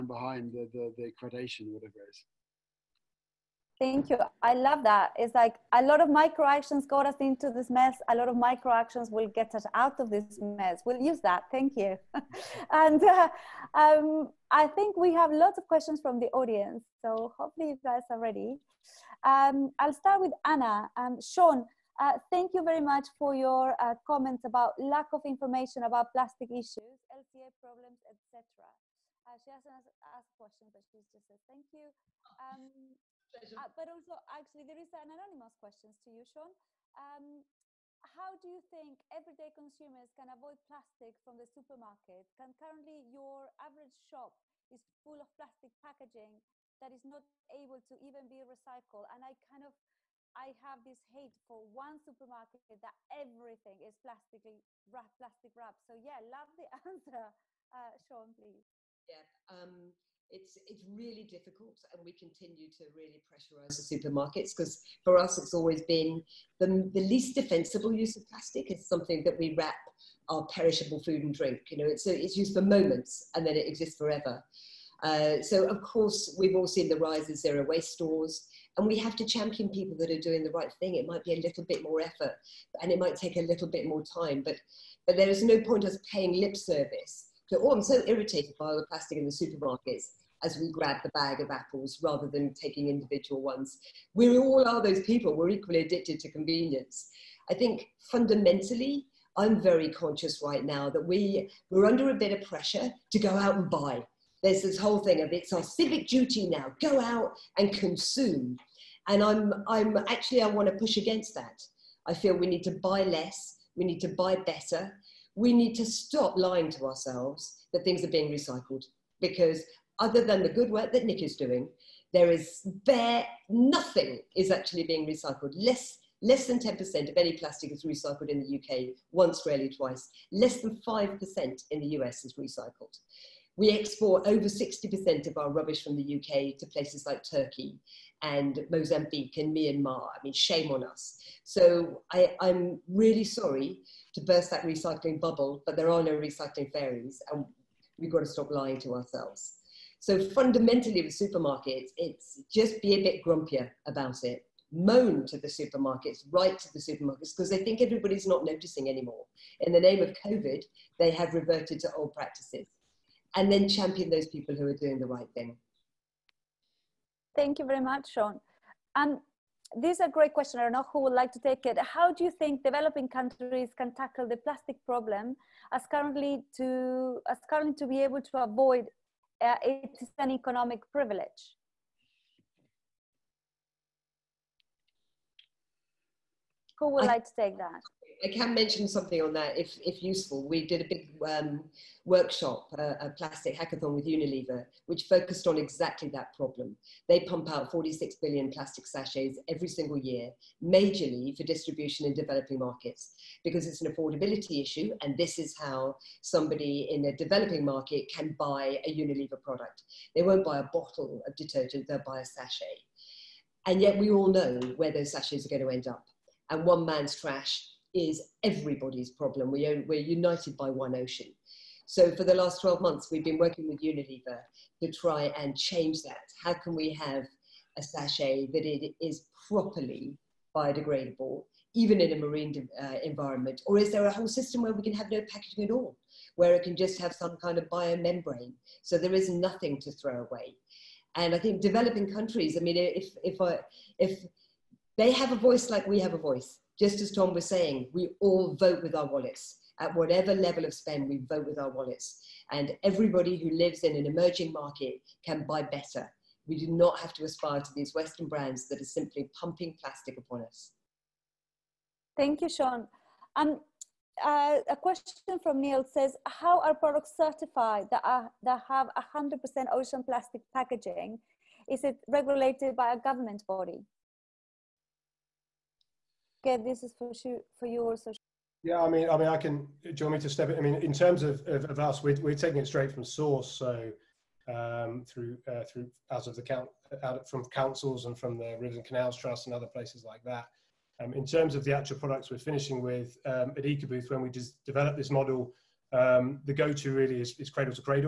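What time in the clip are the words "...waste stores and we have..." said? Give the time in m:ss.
1:17.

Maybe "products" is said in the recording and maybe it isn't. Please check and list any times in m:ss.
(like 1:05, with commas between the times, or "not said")
3:29, 4:26, 4:51.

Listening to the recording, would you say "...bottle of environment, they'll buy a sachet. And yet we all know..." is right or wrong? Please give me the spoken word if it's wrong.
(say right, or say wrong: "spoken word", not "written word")
wrong: "detergent", not "environment".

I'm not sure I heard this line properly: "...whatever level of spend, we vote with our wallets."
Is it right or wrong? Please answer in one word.
right.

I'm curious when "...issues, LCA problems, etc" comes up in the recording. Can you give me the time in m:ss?
0:26.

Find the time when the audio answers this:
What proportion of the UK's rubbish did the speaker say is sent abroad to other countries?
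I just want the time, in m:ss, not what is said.
2:14.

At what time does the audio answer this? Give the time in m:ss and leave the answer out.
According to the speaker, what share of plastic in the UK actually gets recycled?
2:05.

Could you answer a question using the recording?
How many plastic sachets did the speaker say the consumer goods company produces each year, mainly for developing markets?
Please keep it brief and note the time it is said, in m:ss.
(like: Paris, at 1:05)
46 billion, at 3:17.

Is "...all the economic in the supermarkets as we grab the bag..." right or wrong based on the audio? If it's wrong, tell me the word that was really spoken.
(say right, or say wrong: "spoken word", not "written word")
wrong: "plastic", not "economic".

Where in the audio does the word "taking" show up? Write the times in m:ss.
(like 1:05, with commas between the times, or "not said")
1:32, 4:42.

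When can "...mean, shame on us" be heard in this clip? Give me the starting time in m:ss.
2:20.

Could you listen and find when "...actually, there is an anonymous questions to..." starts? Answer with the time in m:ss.
0:34.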